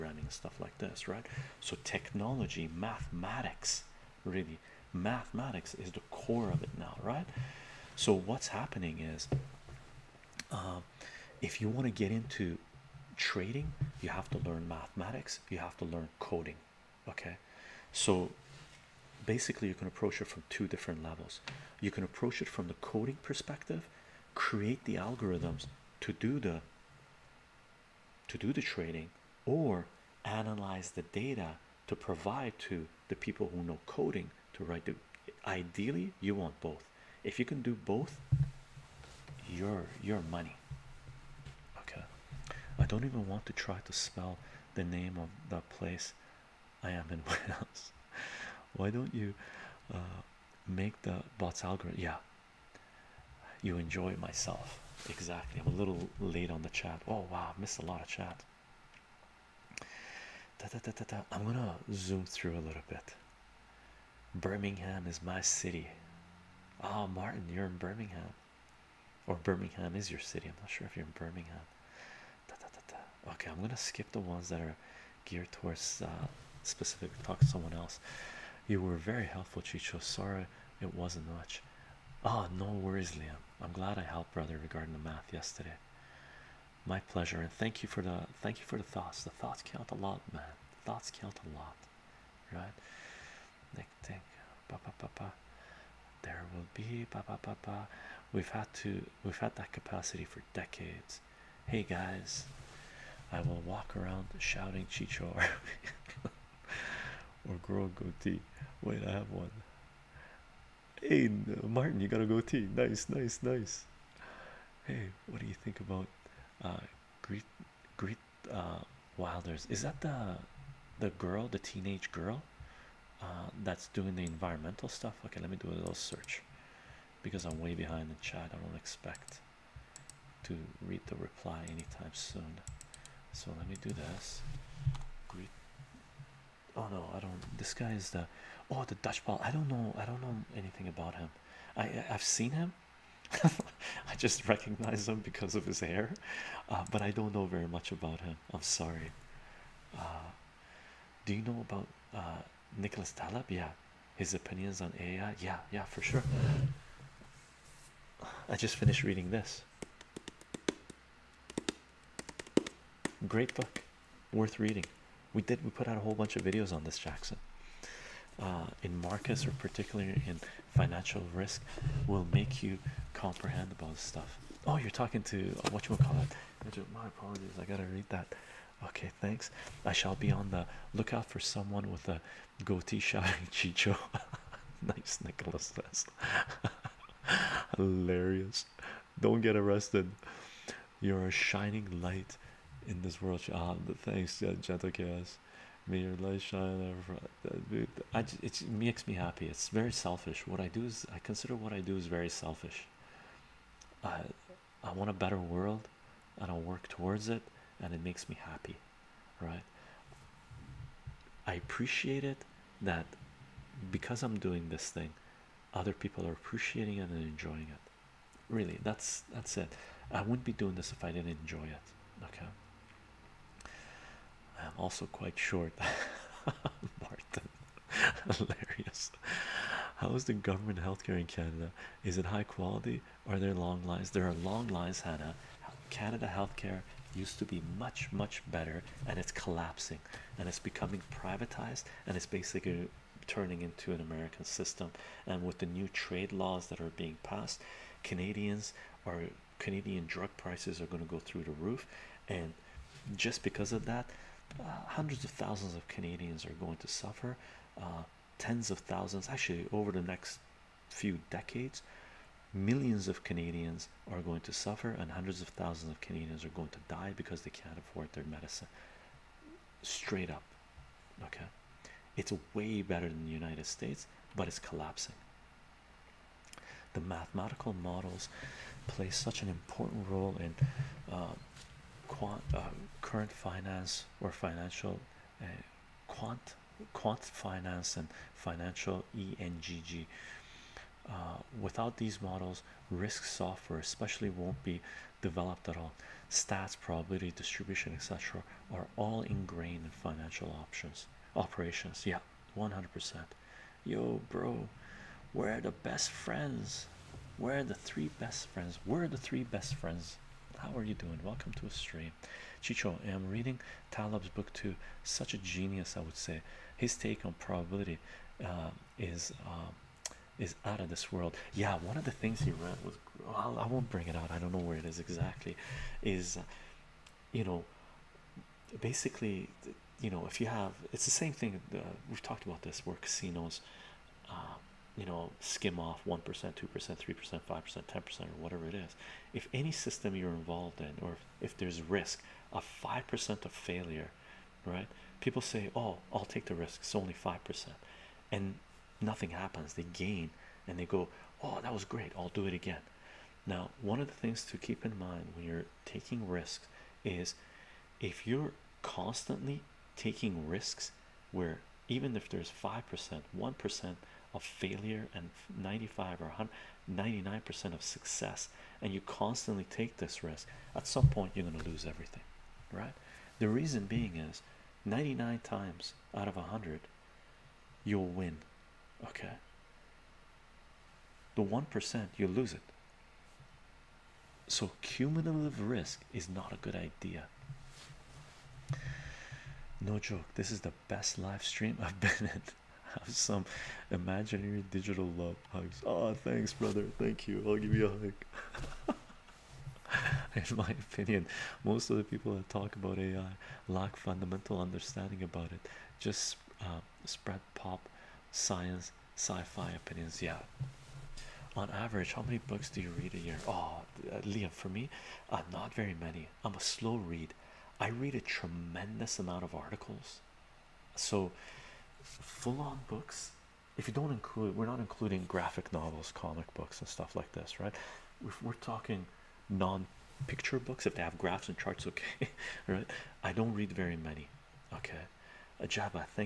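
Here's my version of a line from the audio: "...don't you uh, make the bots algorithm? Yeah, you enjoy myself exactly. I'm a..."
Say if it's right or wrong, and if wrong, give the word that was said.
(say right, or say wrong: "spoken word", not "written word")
right.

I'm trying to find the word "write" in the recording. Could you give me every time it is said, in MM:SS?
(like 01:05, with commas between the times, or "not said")
00:34.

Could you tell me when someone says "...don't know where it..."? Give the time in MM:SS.
05:24.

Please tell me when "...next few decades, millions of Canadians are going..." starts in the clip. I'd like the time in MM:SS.
04:20.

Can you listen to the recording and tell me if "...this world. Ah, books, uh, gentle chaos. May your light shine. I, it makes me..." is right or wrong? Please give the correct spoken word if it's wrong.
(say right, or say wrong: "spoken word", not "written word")
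wrong: "thanks", not "books".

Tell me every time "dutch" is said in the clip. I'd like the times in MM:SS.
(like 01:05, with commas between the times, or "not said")
02:18.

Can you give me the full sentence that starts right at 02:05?
Okay, let me do a little search because I'm way behind the chat.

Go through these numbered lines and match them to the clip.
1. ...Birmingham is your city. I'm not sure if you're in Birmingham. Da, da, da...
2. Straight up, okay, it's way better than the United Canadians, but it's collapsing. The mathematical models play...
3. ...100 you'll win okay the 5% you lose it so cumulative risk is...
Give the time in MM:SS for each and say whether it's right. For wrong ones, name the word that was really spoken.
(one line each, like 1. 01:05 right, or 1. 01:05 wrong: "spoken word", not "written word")
1. 01:09 right
2. 04:29 wrong: "States", not "Canadians"
3. 06:16 wrong: "1", not "5".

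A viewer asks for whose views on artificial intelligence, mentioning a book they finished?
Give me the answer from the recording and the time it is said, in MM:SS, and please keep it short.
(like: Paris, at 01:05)
Nicholas Taleb, at 02:32.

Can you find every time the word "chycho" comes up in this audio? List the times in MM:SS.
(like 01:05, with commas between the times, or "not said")
01:19, 01:44, 03:03, 05:12.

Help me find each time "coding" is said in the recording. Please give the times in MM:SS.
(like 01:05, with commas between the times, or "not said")
00:16, 00:22, 00:33.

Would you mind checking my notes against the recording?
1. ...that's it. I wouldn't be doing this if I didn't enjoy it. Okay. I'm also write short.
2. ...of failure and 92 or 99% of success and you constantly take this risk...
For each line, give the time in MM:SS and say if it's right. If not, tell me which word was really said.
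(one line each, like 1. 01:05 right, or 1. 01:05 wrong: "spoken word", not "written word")
1. 03:39 wrong: "quite", not "write"
2. 06:04 wrong: "95", not "92".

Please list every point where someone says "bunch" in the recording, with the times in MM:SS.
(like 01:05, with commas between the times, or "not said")
02:46.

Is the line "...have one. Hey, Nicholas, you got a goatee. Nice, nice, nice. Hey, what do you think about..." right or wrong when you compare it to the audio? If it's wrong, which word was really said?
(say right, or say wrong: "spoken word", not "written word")
wrong: "Martin", not "Nicholas".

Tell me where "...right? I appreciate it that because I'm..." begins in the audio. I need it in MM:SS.
03:29.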